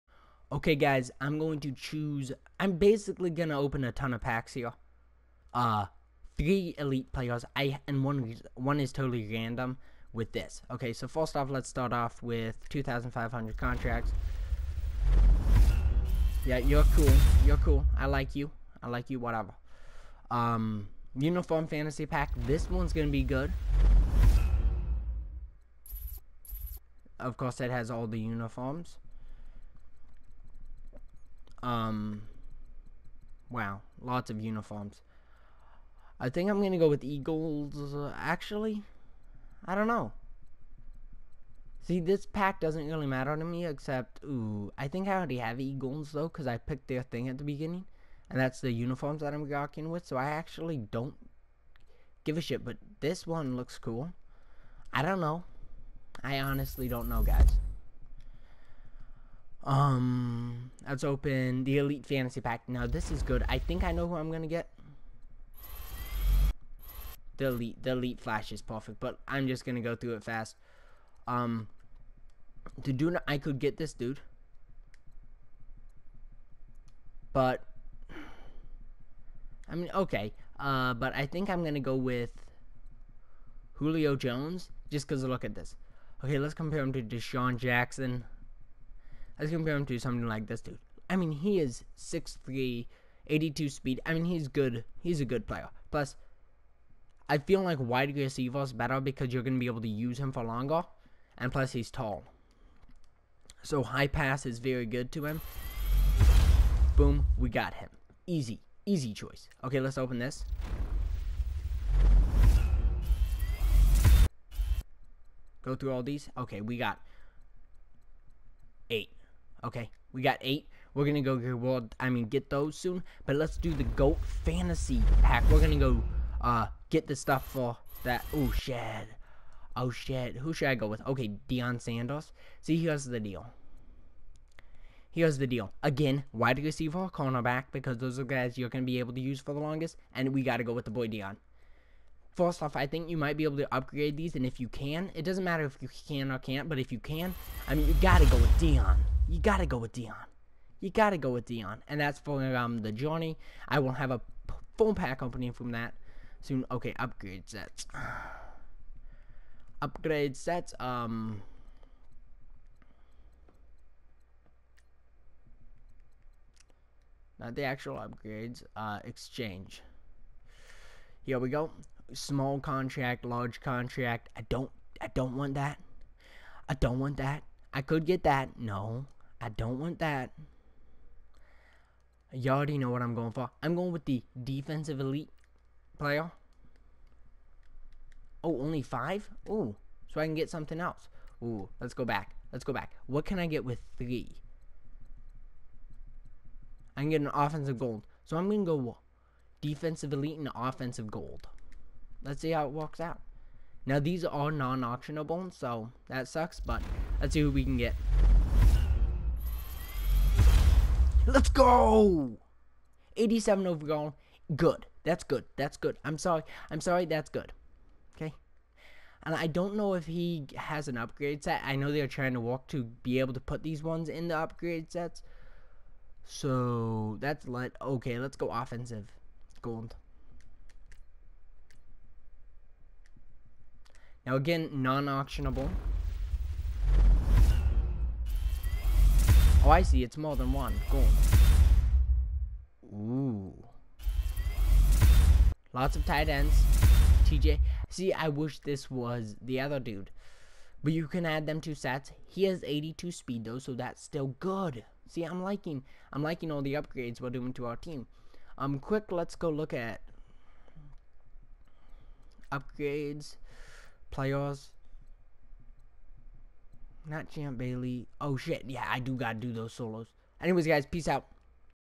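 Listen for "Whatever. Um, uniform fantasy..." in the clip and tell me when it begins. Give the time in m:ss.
0:19.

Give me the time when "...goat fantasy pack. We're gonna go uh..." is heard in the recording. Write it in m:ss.
2:03.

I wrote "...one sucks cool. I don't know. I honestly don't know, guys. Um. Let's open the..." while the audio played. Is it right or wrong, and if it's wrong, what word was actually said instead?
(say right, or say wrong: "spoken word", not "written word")
wrong: "looks", not "sucks".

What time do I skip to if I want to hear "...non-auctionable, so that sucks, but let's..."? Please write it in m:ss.
3:24.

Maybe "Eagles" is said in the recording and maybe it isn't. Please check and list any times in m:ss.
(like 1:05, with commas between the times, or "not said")
0:37, 0:45.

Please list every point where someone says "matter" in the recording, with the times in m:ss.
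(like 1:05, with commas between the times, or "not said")
0:43, 2:25.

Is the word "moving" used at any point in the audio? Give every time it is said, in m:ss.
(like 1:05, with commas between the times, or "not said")
not said.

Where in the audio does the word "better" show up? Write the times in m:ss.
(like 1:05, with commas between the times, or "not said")
1:38.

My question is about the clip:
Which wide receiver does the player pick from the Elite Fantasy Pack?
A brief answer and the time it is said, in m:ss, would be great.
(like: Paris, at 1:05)
Julio Jones, at 1:23.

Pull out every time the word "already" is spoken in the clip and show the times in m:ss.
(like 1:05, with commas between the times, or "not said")
0:45, 3:02.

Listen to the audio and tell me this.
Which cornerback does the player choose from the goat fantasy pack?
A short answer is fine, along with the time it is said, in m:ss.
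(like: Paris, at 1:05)
Deion Sanders, at 2:11.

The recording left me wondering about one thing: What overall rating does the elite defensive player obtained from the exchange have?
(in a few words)
87.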